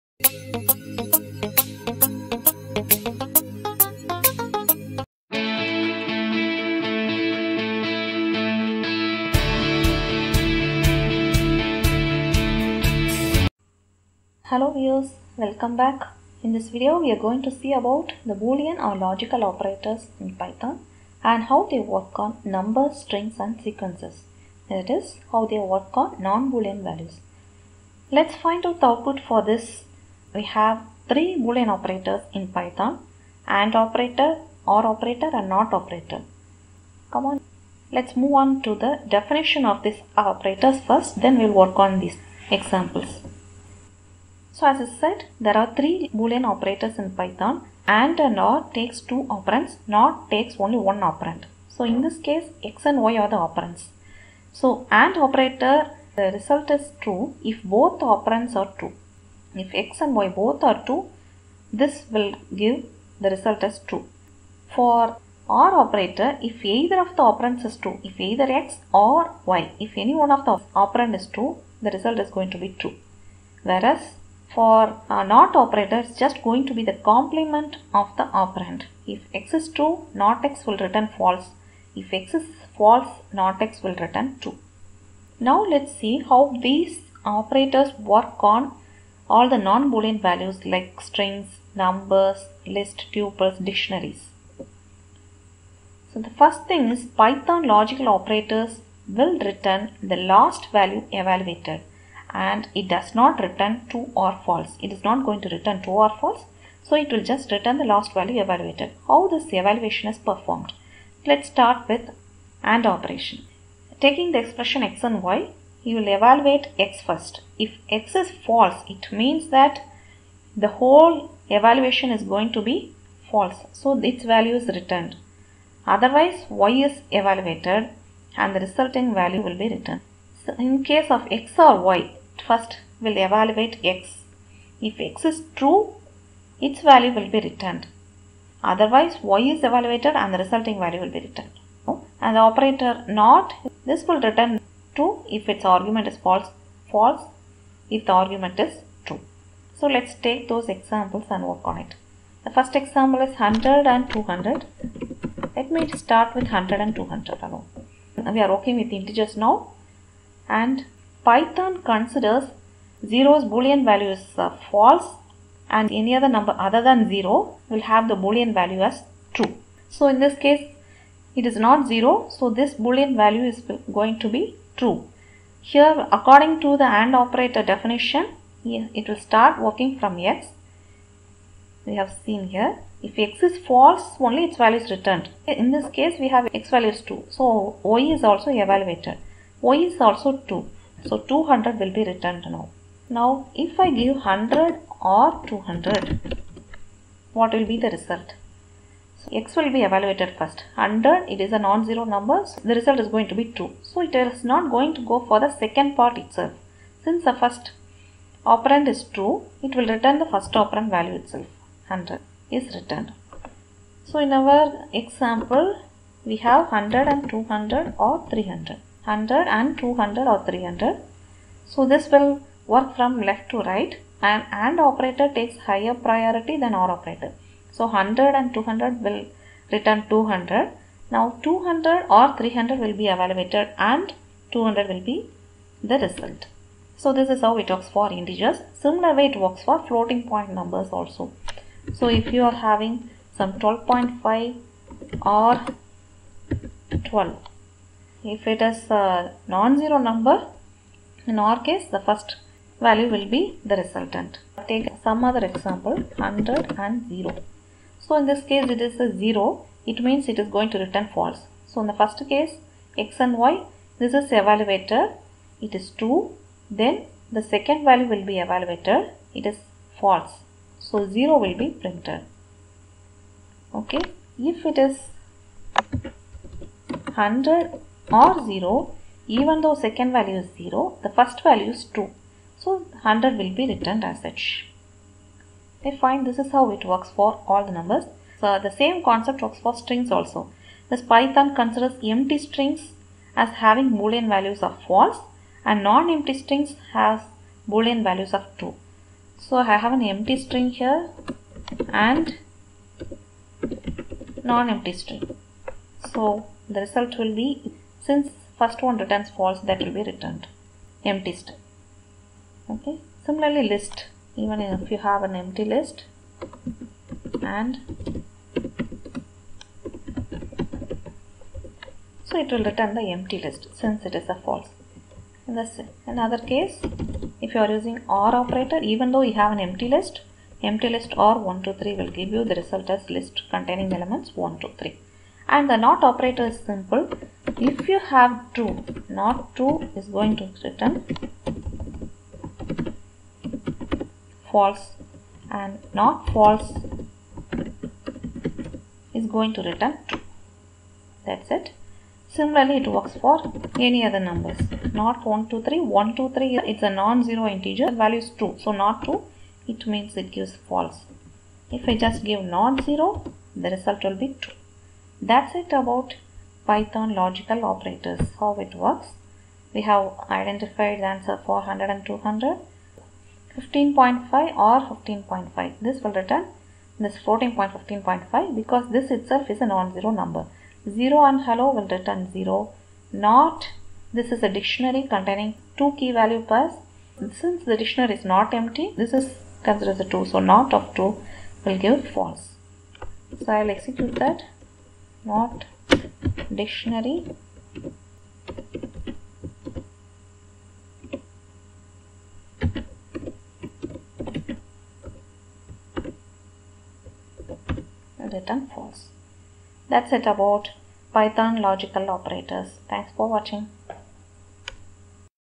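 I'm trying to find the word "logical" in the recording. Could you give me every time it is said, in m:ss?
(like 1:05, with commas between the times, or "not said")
0:18, 1:37, 6:07, 6:51.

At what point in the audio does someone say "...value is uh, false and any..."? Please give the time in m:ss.
2:43.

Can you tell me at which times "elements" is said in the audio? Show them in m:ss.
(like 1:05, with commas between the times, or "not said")
5:33.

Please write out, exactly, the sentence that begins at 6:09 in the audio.
We have identified the answer 400 and 200, 15.5 or 15.5.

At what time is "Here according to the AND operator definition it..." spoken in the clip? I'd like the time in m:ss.
2:55.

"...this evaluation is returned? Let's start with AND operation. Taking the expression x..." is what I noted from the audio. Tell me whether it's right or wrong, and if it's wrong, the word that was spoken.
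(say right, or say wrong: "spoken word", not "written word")
wrong: "performed", not "returned".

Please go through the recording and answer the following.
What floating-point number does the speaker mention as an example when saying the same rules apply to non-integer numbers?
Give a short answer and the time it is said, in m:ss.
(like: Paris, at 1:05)
12.5, at 4:03.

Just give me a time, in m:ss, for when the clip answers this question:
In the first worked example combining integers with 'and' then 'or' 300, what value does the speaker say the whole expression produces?
3:54.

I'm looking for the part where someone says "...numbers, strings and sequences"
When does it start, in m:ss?
0:22.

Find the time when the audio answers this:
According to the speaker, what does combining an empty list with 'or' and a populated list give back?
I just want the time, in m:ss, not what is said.
5:33.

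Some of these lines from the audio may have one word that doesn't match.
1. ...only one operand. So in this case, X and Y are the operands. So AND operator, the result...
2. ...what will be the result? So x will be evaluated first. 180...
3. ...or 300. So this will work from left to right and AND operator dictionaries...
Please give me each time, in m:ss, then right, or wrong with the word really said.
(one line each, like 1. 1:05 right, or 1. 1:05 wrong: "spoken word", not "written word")
1. 0:50 right
2. 3:17 wrong: "100", not "180"
3. 3:40 wrong: "takes", not "dictionaries".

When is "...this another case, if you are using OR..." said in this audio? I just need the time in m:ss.
5:25.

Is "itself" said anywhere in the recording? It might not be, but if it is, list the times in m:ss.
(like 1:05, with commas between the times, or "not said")
3:26, 3:31, 6:19.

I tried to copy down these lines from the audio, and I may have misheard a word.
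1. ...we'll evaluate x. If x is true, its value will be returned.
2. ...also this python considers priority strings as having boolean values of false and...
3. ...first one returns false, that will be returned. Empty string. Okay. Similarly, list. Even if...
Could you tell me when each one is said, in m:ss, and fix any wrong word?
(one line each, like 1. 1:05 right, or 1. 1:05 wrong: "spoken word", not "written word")
1. 2:12 right
2. 4:50 wrong: "empty", not "priority"
3. 5:08 right.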